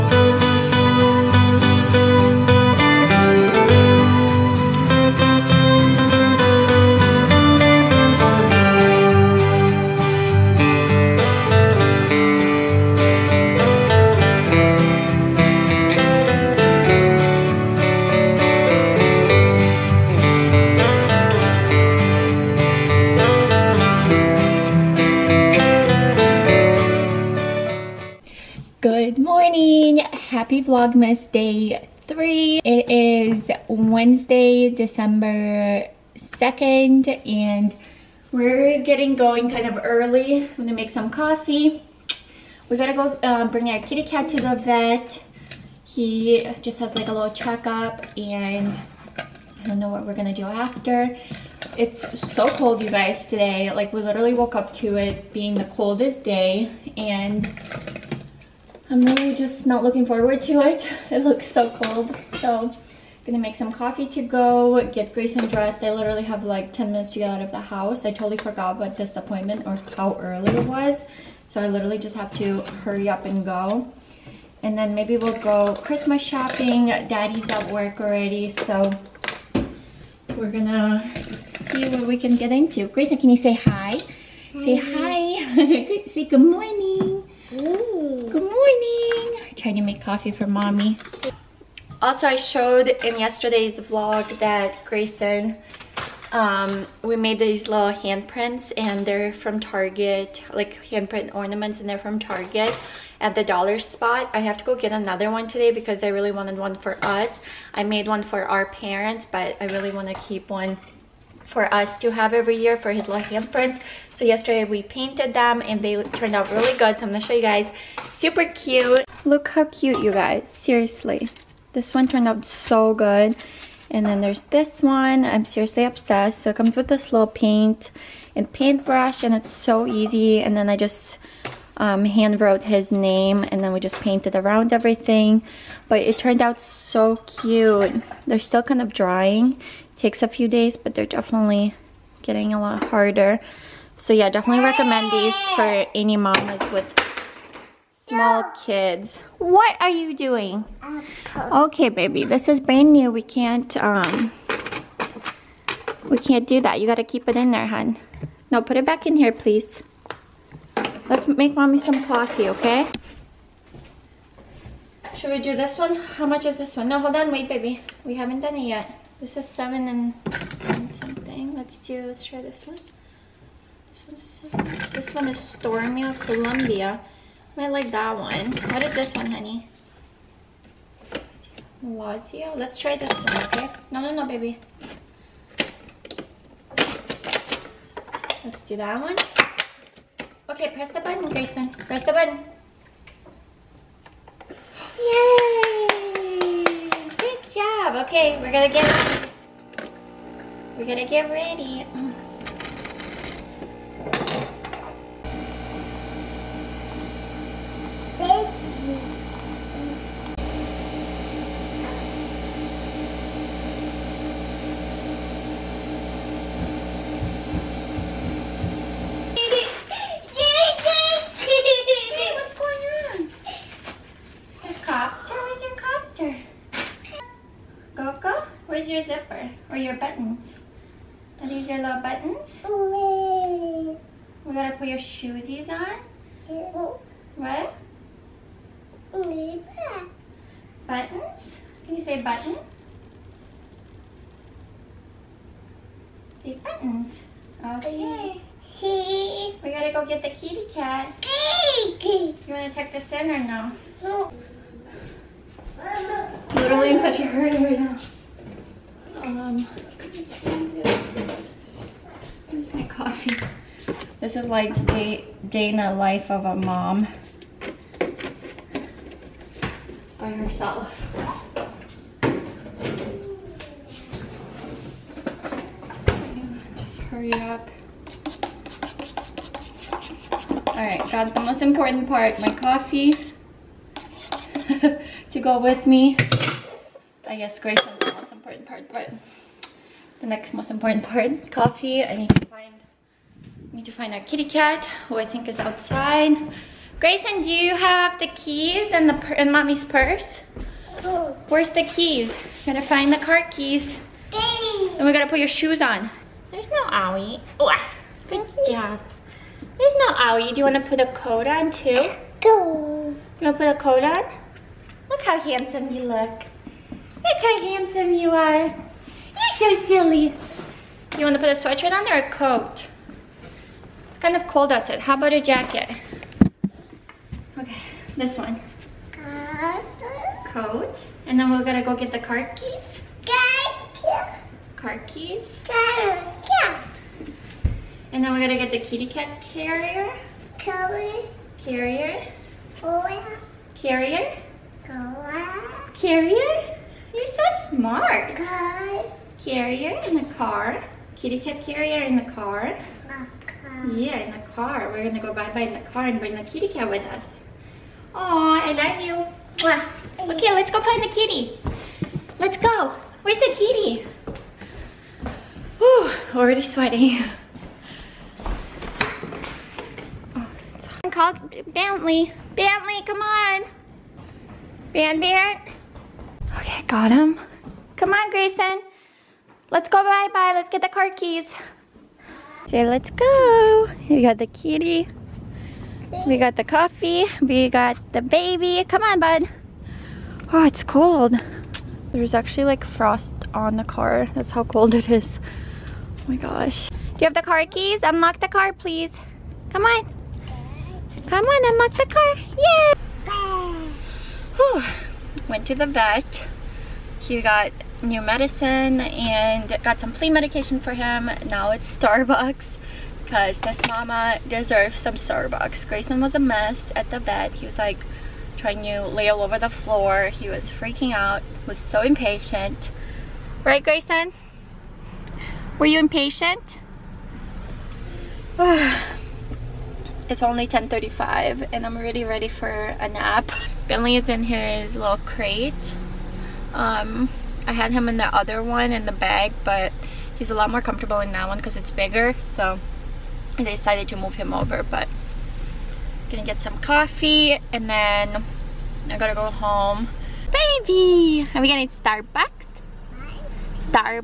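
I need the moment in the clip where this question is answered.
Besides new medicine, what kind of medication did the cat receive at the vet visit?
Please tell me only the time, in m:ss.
6:50.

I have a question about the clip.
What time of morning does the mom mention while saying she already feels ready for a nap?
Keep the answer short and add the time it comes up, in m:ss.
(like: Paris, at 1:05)
10:35, at 7:10.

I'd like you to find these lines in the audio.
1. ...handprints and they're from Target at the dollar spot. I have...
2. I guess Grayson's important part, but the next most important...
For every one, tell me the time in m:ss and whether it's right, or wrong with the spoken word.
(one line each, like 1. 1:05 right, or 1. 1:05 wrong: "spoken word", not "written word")
1. 1:41 wrong: "ornaments", not "handprints"
2. 4:47 right.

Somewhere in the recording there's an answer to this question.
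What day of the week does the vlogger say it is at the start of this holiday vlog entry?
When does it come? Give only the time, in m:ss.
0:33.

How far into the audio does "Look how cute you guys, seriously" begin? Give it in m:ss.
1:59.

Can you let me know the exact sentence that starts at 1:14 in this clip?
And then maybe we'll go Christmas shopping.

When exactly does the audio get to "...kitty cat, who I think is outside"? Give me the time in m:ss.
4:54.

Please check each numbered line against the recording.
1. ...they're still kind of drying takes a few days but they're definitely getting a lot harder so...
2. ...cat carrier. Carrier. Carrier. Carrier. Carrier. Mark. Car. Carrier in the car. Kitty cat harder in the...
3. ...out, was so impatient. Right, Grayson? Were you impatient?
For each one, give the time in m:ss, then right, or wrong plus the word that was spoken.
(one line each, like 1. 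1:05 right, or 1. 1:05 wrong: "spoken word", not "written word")
1. 2:18 right
2. 5:39 wrong: "carrier", not "harder"
3. 7:01 right.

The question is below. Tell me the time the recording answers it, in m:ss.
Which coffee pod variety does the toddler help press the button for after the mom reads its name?
3:01.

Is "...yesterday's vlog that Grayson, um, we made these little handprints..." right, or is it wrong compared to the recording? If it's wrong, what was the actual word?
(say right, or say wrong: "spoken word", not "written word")
right.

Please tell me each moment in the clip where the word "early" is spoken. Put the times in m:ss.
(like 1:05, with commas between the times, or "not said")
0:39, 1:10.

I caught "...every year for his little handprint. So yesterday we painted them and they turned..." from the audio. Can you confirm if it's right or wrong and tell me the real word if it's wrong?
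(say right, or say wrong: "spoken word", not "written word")
right.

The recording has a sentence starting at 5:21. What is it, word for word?
You want to put a sweatshirt on or a coat?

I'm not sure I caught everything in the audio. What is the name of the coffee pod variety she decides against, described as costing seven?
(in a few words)
Stormio Columbia.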